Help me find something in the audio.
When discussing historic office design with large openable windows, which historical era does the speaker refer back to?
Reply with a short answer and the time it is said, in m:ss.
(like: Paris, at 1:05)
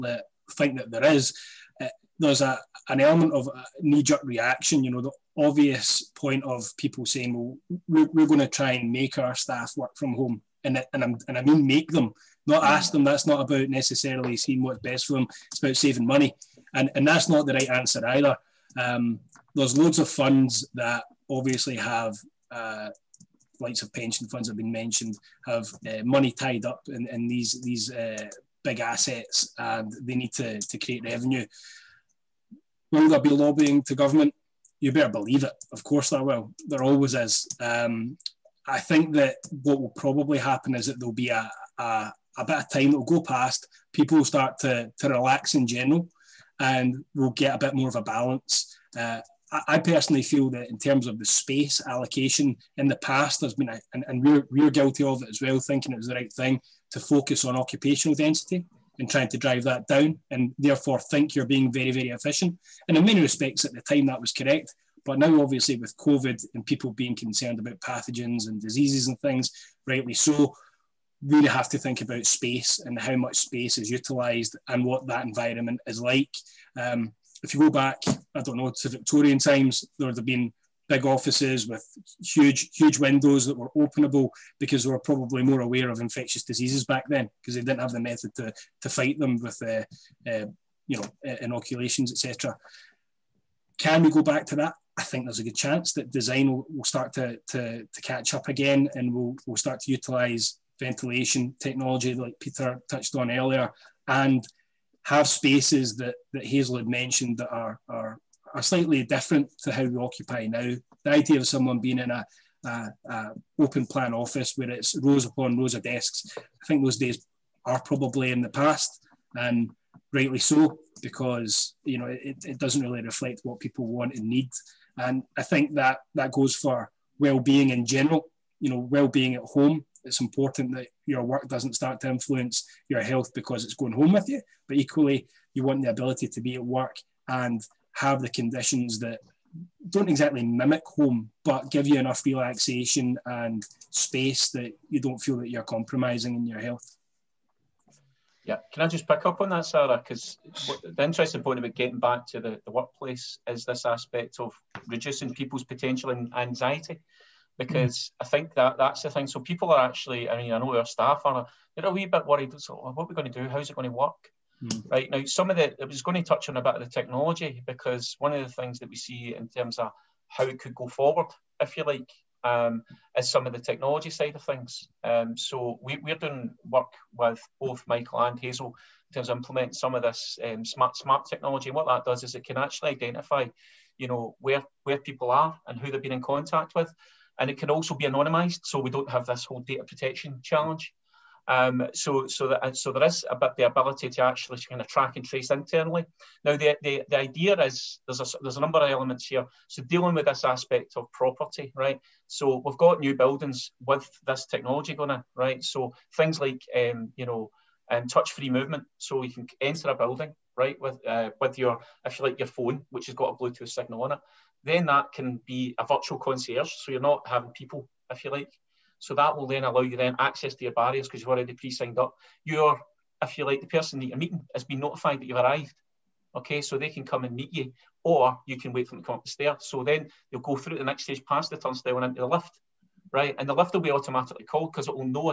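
Victorian times, at 1:18.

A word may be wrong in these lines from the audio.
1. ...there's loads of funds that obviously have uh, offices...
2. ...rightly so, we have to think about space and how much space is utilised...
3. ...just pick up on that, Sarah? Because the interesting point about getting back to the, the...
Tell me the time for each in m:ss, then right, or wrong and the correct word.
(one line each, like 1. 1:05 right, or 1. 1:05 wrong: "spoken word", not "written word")
1. 0:19 wrong: "likes", not "offices"
2. 1:09 right
3. 2:28 right.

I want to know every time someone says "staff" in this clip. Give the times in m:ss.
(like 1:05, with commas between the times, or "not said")
0:09, 2:40.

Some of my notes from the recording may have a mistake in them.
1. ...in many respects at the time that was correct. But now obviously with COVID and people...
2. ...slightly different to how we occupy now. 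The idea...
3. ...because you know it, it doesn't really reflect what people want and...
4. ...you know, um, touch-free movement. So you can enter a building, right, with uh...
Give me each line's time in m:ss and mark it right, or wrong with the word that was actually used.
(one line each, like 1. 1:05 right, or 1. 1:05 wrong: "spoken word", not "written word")
1. 1:02 right
2. 1:48 right
3. 2:01 right
4. 3:27 right.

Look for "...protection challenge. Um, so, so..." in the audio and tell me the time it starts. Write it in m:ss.
3:09.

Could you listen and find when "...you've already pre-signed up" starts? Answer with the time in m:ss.
3:41.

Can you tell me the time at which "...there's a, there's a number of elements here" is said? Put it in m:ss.
3:18.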